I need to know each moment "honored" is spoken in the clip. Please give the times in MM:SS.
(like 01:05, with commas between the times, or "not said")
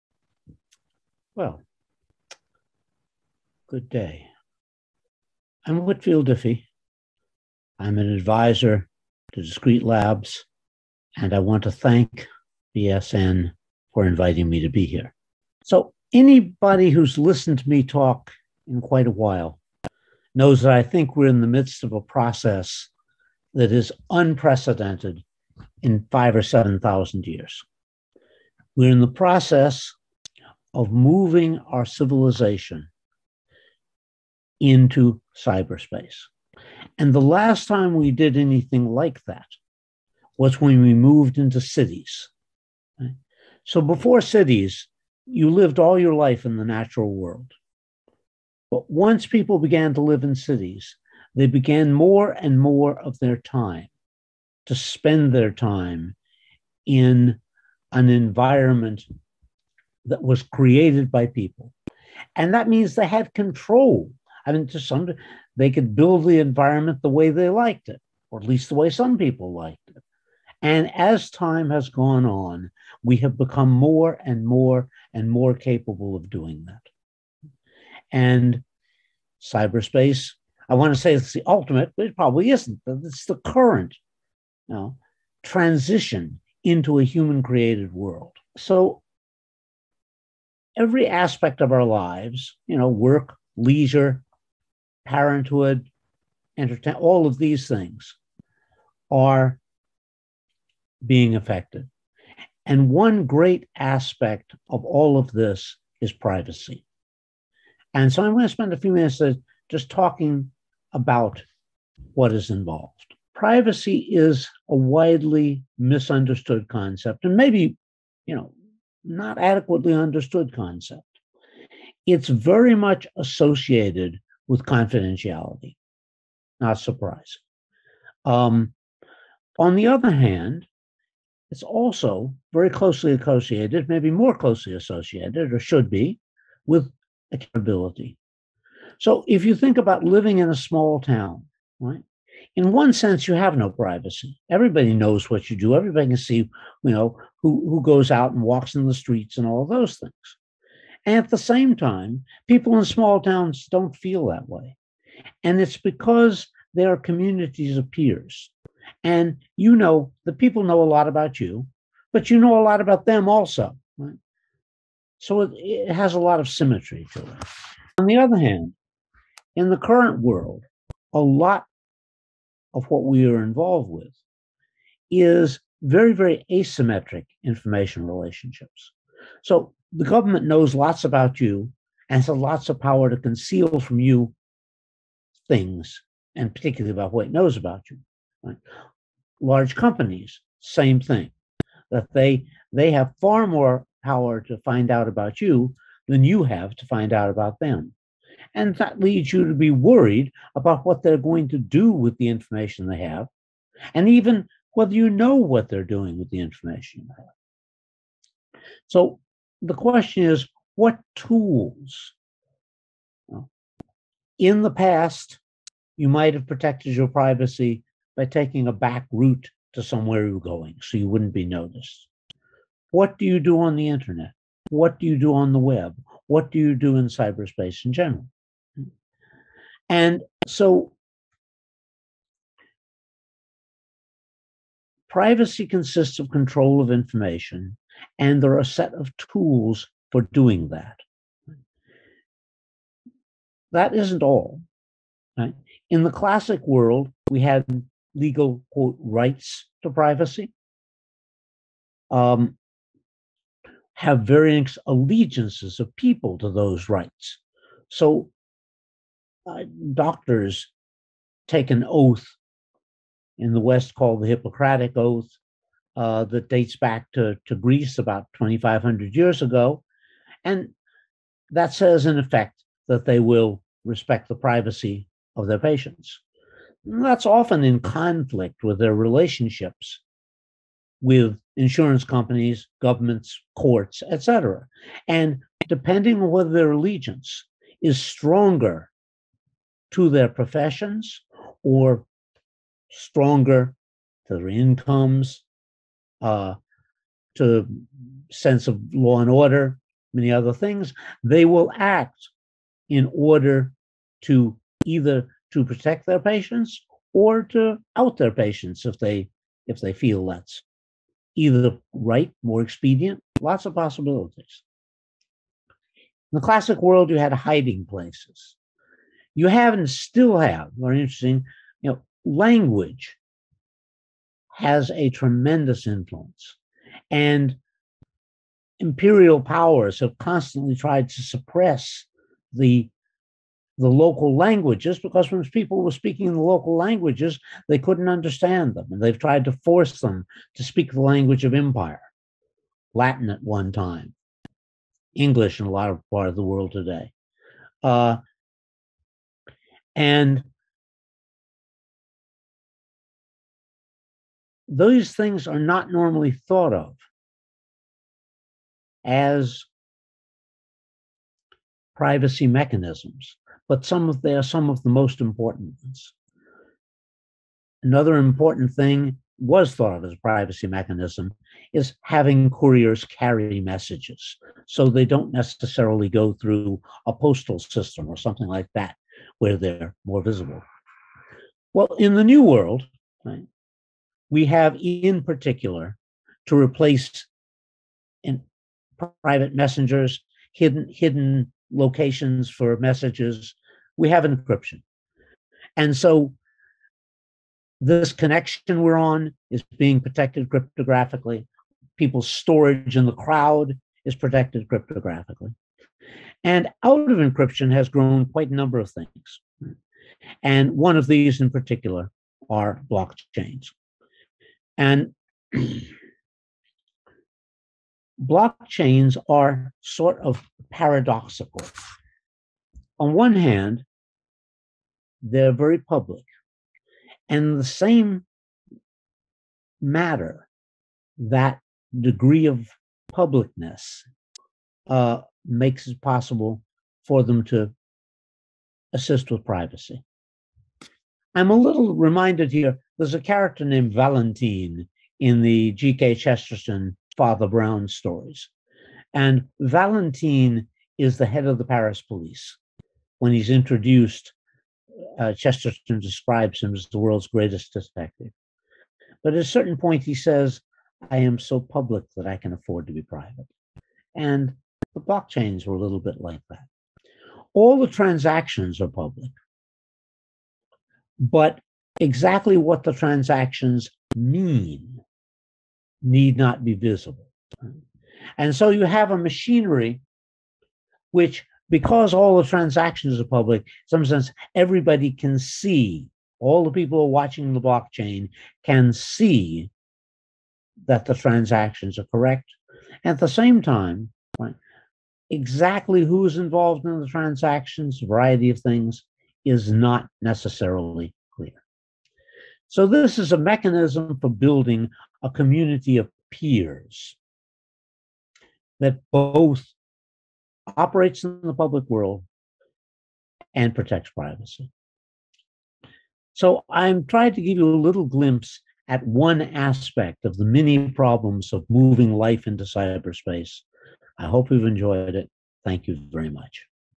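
not said.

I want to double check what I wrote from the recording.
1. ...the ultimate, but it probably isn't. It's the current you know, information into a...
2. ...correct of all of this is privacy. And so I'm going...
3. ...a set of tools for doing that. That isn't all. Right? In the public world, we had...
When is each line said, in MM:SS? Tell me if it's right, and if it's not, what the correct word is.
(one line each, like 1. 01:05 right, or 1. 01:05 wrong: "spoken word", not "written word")
1. 01:21 wrong: "transition", not "information"
2. 01:43 wrong: "aspect", not "correct"
3. 03:58 wrong: "classic", not "public".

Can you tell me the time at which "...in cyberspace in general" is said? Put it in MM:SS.
03:46.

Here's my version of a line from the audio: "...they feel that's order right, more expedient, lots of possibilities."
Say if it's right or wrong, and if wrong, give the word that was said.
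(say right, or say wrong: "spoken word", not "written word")
wrong: "either", not "order".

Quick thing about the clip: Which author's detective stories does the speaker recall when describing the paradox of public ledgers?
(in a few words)
G.K. Chesterton.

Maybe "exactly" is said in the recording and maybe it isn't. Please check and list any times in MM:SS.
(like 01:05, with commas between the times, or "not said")
07:52, 08:15.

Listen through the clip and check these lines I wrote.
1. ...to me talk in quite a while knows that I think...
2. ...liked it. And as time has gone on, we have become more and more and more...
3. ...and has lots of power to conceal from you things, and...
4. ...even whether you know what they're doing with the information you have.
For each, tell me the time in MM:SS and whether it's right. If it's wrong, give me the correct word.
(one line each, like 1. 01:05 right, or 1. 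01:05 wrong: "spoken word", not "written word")
1. 00:17 right
2. 01:09 right
3. 03:02 right
4. 03:24 right.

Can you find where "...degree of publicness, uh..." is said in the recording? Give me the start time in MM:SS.
07:11.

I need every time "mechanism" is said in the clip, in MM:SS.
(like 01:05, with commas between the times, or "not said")
06:02, 06:10, 08:23.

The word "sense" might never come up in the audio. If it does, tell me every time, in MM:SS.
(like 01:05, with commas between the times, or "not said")
02:22, 04:58, 08:04.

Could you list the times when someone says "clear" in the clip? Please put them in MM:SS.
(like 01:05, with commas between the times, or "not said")
08:21.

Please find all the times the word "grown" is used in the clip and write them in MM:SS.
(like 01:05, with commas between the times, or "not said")
06:47.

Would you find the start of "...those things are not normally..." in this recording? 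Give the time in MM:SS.
05:54.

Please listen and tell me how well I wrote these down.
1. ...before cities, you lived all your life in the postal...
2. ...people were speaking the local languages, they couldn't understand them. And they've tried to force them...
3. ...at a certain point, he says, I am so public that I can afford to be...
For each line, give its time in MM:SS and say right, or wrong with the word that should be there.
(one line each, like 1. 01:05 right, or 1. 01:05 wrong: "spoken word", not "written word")
1. 00:43 wrong: "natural", not "postal"
2. 05:35 right
3. 07:39 right.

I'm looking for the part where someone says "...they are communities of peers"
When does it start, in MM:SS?
02:36.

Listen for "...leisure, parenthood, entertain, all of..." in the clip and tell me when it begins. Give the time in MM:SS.
01:33.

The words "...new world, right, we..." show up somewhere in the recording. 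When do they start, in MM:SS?
06:22.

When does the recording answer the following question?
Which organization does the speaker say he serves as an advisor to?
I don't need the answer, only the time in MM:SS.
00:09.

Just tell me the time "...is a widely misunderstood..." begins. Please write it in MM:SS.
01:54.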